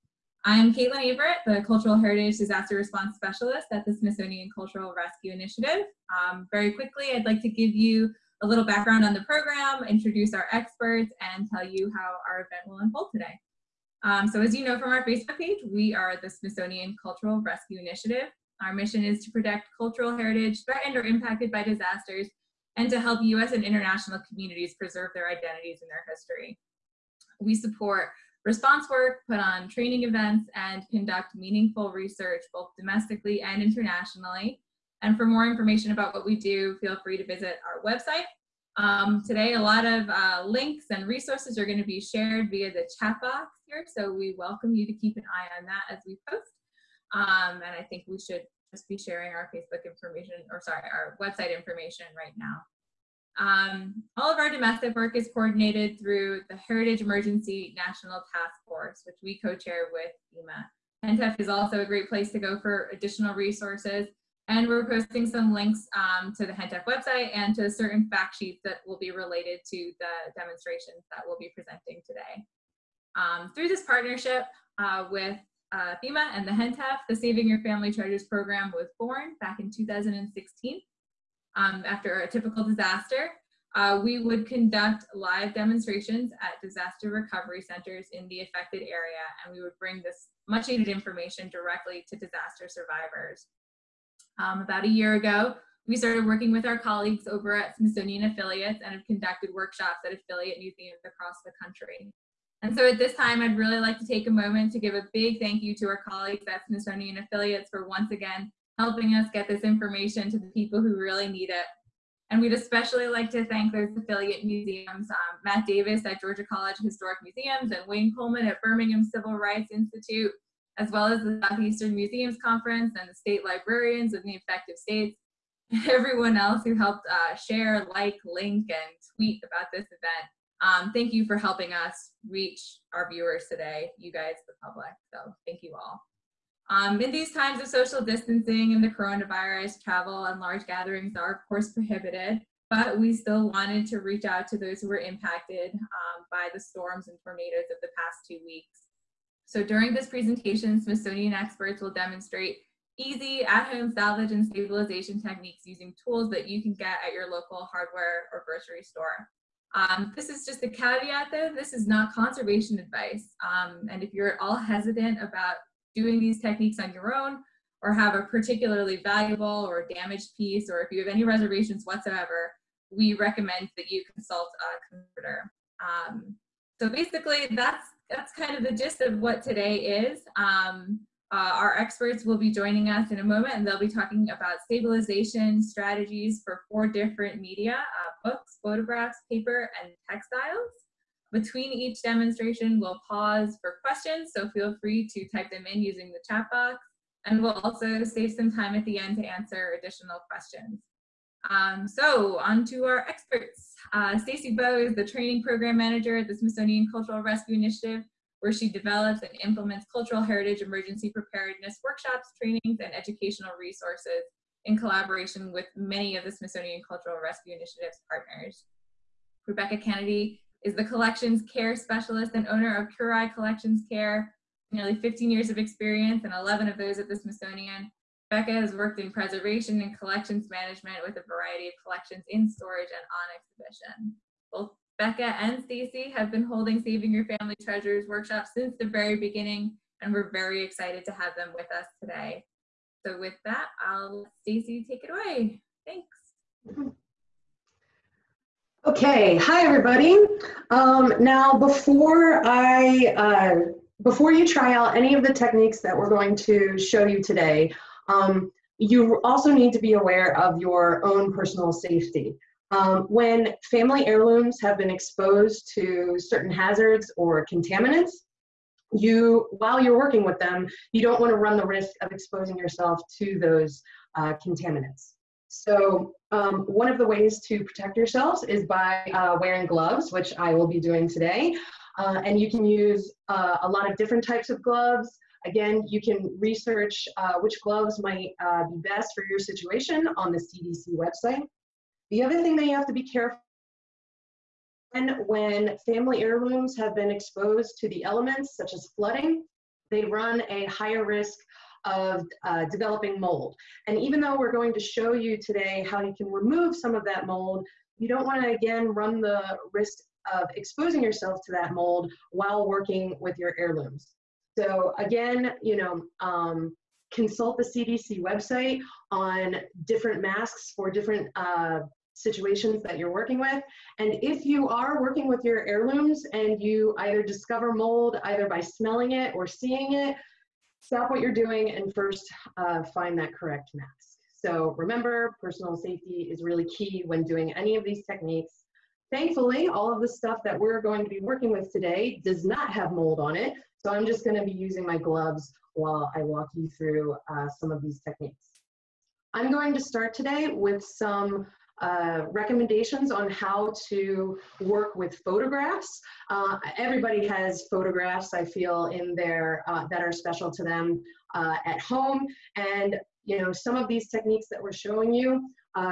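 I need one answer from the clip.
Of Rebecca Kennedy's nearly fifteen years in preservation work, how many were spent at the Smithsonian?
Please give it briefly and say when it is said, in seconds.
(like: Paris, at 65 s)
11, at 226 s.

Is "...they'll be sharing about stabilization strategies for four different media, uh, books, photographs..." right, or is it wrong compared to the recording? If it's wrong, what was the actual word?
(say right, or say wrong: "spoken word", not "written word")
wrong: "talking", not "sharing".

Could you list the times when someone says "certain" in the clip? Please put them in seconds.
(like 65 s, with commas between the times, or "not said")
67 s, 266 s.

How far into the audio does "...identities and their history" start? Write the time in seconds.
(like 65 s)
25 s.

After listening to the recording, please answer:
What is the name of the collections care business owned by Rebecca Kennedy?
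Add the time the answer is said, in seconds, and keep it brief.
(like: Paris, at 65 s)
Curai Collections Care, at 222 s.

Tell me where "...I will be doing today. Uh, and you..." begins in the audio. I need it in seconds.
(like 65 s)
280 s.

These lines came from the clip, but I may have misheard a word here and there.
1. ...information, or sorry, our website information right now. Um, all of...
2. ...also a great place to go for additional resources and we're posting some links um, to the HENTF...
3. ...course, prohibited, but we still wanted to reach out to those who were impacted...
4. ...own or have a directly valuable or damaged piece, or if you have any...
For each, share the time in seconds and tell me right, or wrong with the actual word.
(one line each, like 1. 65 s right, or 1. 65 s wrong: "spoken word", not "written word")
1. 49 s right
2. 61 s right
3. 141 s right
4. 167 s wrong: "particularly", not "directly".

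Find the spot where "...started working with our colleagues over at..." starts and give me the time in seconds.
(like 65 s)
95 s.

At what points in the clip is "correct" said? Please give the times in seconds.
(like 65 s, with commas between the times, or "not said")
333 s.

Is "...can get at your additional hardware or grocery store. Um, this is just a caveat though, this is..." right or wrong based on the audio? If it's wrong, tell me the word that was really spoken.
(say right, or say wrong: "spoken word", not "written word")
wrong: "local", not "additional".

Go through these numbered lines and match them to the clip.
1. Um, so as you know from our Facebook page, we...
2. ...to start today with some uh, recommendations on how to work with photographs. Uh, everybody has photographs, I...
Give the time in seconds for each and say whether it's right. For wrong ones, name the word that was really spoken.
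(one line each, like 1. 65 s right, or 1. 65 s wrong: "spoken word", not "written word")
1. 14 s right
2. 349 s right.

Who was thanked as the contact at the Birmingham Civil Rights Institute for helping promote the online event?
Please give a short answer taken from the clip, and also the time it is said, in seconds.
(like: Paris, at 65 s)
Wayne Coleman, at 117 s.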